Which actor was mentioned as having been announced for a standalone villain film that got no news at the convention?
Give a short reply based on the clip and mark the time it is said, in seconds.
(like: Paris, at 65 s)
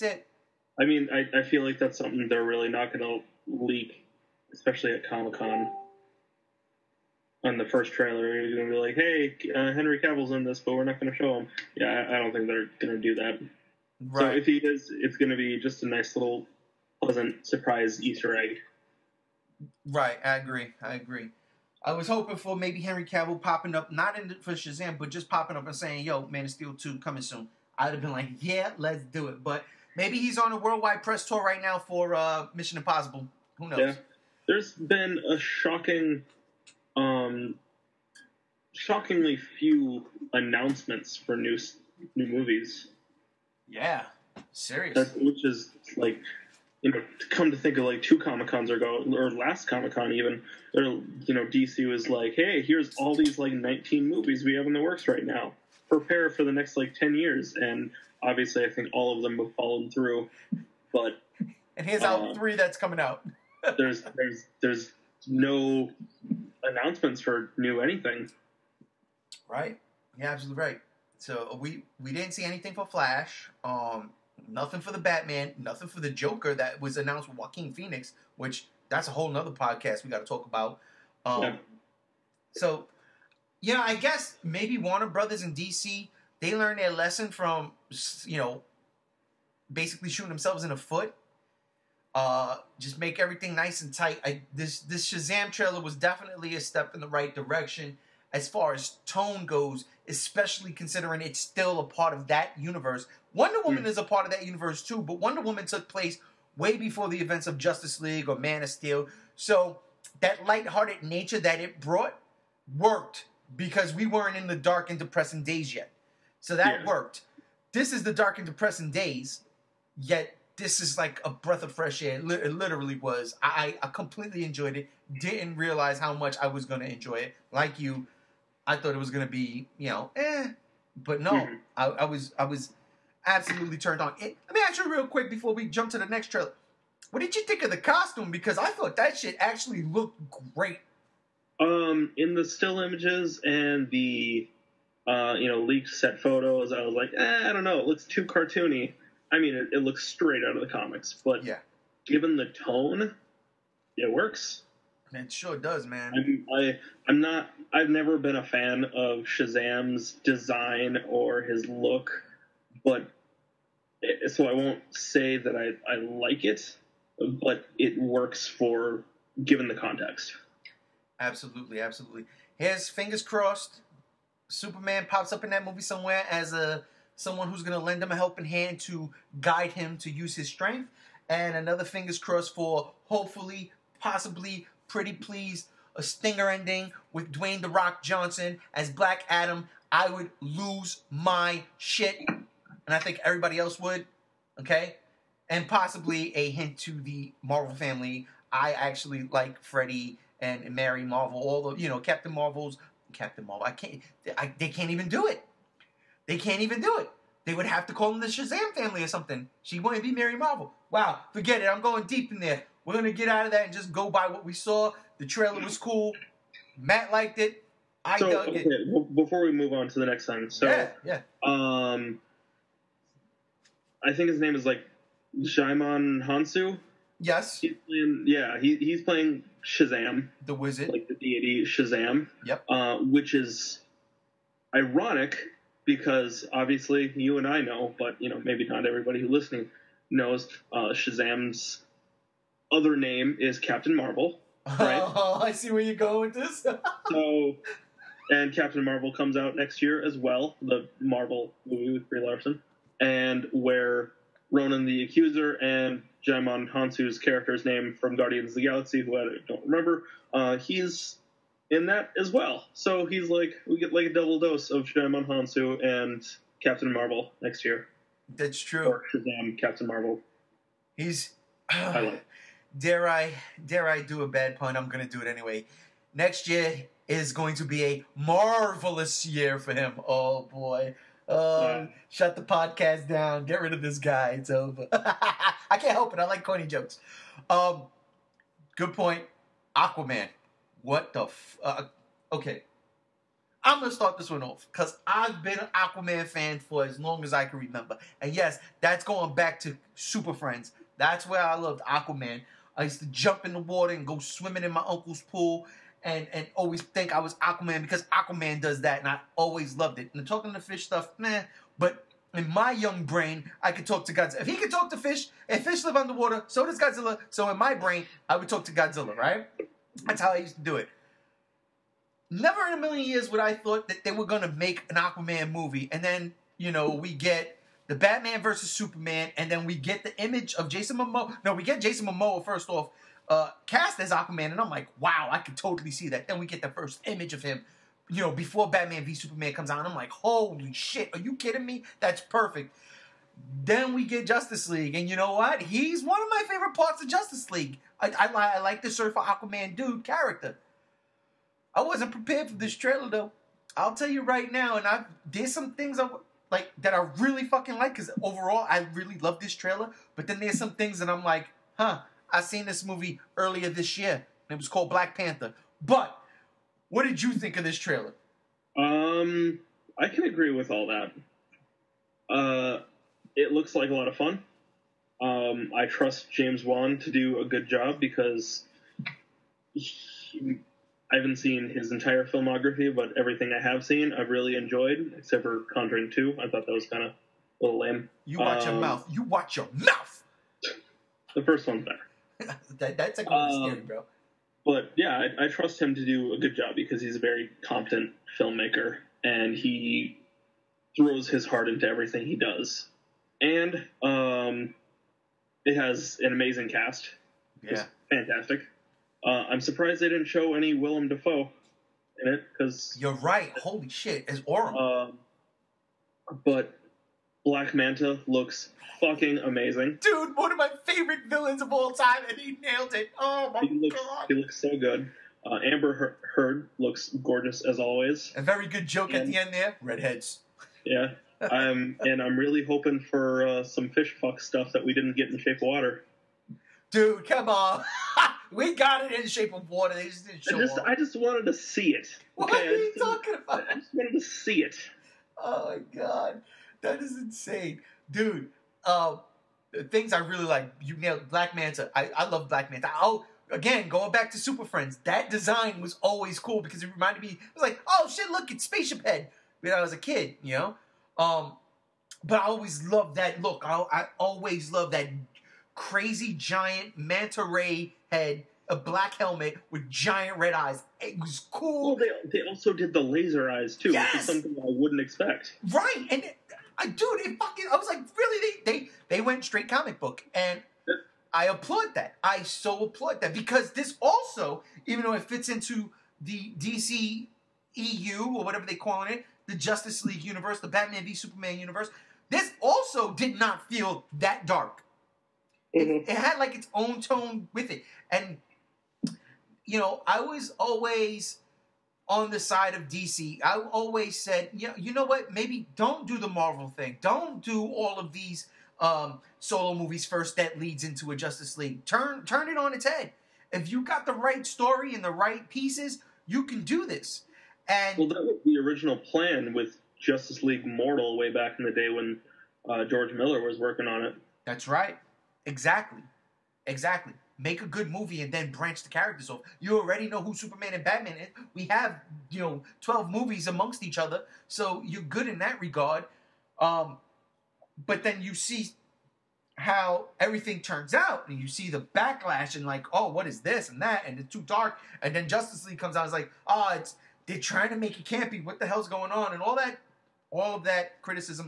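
Joaquin Phoenix, at 77 s.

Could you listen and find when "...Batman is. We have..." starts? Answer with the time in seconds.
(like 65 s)
530 s.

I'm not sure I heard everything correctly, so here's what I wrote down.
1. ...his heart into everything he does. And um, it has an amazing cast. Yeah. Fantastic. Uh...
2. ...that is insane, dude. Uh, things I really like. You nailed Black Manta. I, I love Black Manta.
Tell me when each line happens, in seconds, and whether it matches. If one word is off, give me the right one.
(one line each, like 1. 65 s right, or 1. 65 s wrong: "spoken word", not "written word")
1. 401 s right
2. 446 s right.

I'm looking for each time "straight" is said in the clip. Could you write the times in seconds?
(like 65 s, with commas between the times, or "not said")
150 s, 479 s.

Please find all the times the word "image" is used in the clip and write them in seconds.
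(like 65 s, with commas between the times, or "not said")
142 s, 330 s, 337 s.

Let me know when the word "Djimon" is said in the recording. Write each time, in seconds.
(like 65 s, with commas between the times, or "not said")
225 s, 256 s, 264 s.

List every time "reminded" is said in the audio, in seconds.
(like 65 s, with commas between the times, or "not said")
456 s.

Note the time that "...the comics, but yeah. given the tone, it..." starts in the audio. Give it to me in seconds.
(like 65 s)
150 s.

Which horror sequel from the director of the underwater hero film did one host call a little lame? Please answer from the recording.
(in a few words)
Conjuring Two.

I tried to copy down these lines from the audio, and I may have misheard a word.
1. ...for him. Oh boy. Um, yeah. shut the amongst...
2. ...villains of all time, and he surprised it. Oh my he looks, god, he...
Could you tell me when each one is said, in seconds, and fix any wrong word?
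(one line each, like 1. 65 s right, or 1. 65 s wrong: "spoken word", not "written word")
1. 279 s wrong: "podcast", not "amongst"
2. 421 s wrong: "nailed", not "surprised".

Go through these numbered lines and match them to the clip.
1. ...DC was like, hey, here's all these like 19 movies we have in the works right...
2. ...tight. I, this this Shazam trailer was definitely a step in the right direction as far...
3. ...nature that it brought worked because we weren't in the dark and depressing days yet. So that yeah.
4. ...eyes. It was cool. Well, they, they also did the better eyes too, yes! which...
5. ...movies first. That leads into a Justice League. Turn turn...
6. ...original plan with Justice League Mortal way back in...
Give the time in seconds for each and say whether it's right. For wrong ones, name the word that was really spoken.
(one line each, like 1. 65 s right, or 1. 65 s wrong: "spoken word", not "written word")
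1. 51 s right
2. 93 s right
3. 111 s right
4. 470 s wrong: "laser", not "better"
5. 509 s right
6. 518 s right.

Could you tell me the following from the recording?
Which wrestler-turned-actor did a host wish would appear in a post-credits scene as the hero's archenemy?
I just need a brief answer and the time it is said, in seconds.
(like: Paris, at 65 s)
Dwayne The Rock Johnson, at 187 s.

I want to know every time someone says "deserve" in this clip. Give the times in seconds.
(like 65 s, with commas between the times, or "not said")
not said.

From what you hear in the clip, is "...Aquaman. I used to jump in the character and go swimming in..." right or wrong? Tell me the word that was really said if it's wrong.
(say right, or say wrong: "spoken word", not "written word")
wrong: "water", not "character".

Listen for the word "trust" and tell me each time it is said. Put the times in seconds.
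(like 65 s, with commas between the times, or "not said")
375 s, 395 s.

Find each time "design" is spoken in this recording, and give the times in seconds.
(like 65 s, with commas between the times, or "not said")
160 s, 455 s.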